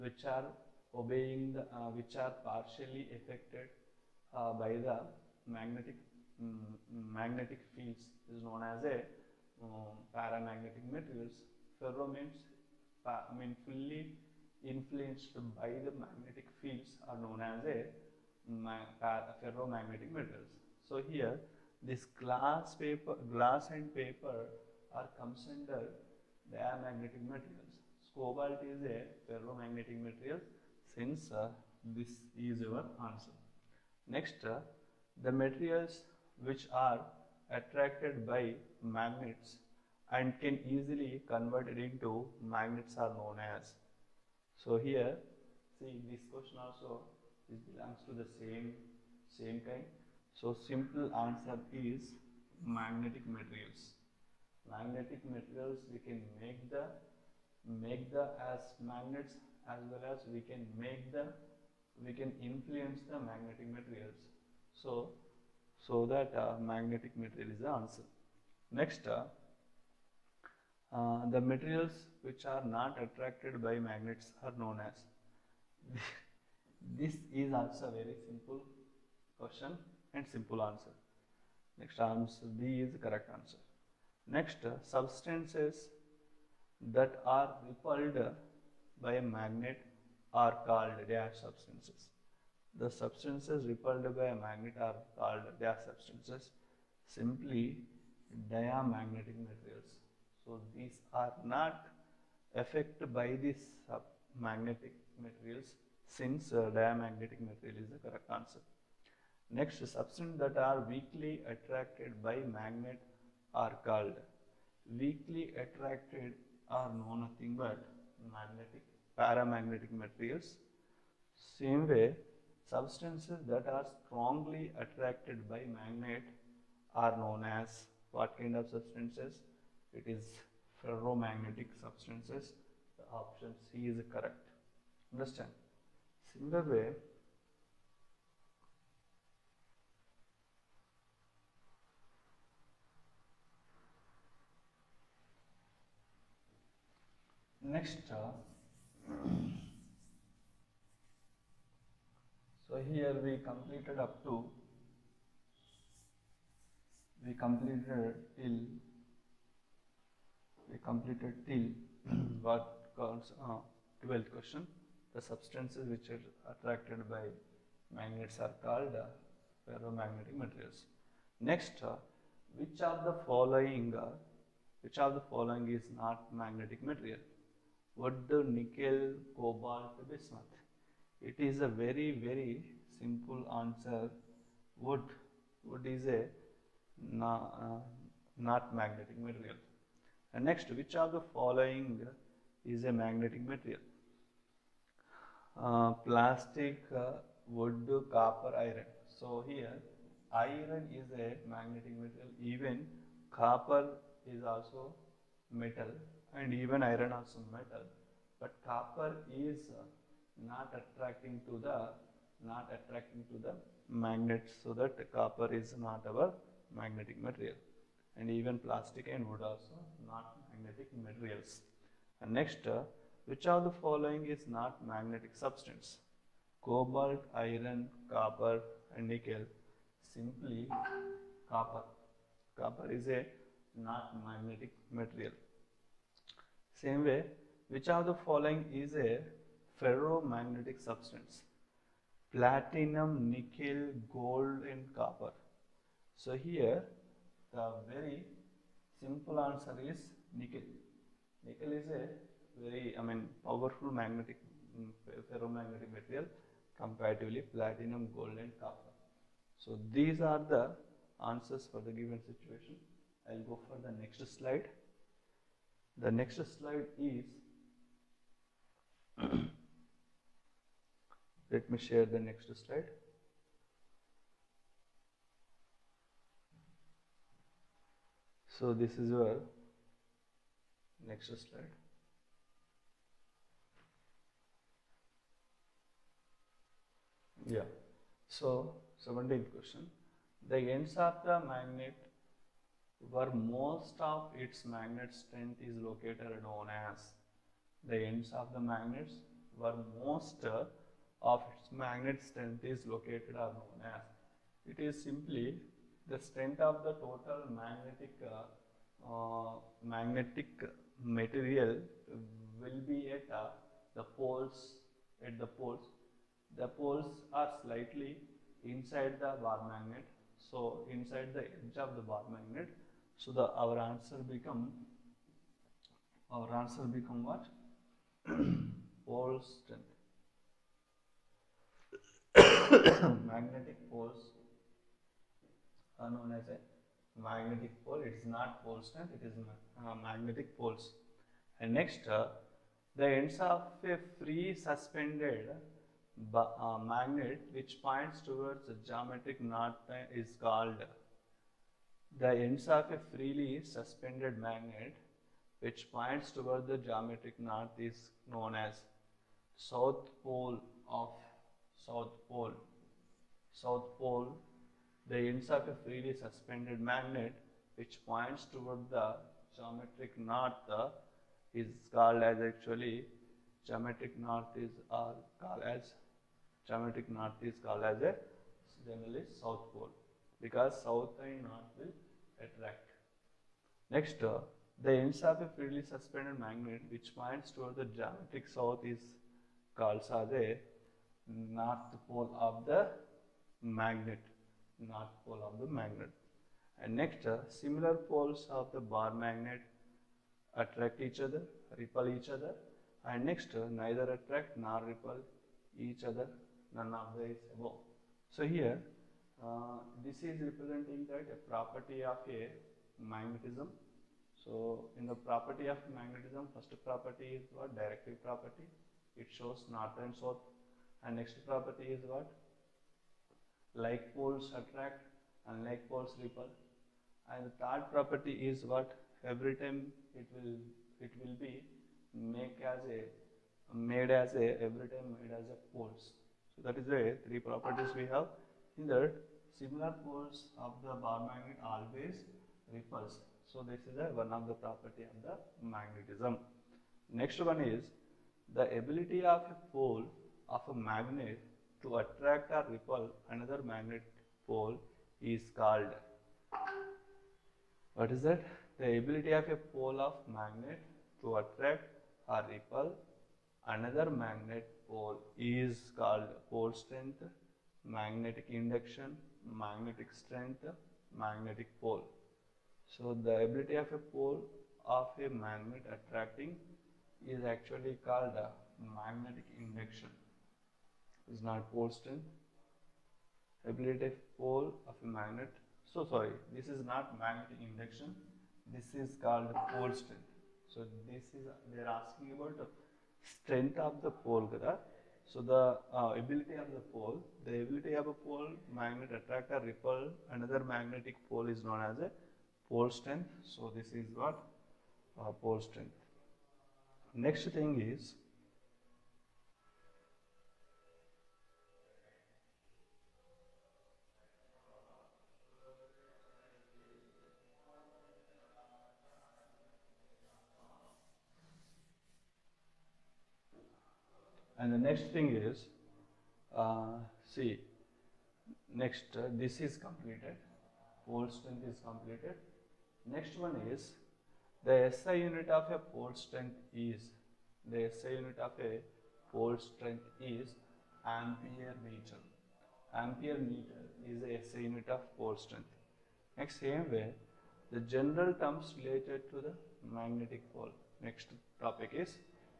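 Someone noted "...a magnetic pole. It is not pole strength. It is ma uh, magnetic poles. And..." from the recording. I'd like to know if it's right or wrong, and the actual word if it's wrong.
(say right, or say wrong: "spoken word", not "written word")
right.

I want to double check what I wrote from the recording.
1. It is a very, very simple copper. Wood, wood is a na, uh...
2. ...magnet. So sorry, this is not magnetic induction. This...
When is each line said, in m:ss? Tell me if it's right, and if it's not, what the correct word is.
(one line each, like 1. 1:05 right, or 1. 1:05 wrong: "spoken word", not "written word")
1. 3:01 wrong: "answer", not "copper"
2. 8:05 right.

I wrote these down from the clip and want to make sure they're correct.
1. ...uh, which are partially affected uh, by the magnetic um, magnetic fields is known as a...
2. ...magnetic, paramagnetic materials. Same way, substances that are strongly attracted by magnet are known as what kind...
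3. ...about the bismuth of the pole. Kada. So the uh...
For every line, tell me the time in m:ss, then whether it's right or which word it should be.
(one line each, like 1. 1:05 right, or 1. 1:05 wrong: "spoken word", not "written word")
1. 0:01 right
2. 1:58 right
3. 8:12 wrong: "strength", not "bismuth".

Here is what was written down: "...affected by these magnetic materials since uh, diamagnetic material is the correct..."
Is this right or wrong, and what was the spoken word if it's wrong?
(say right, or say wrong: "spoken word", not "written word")
right.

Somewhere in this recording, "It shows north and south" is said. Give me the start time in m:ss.
6:59.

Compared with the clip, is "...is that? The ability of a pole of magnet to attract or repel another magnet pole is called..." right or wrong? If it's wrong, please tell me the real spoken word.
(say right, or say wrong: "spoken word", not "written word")
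right.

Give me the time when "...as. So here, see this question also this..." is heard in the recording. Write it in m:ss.
0:43.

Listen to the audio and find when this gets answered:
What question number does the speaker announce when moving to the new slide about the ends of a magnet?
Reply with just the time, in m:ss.
4:49.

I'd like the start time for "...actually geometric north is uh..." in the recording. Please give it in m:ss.
6:12.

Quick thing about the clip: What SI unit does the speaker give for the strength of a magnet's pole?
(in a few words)
Ampere meter.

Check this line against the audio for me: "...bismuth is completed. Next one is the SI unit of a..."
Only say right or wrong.
wrong.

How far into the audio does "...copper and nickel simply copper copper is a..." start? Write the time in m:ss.
3:48.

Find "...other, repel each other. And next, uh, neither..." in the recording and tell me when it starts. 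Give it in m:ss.
6:41.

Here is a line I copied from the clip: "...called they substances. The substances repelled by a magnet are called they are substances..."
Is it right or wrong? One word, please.
right.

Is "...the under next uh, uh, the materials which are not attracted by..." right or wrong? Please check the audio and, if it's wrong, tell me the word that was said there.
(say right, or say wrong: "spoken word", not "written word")
wrong: "answer", not "under".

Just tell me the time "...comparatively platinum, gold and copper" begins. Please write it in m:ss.
4:16.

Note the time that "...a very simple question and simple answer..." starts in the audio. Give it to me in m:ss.
1:17.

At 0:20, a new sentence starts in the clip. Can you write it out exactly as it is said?
So here this glass paper, glass and paper are comes under they are magnetic materials.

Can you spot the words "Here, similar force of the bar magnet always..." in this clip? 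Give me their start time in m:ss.
7:18.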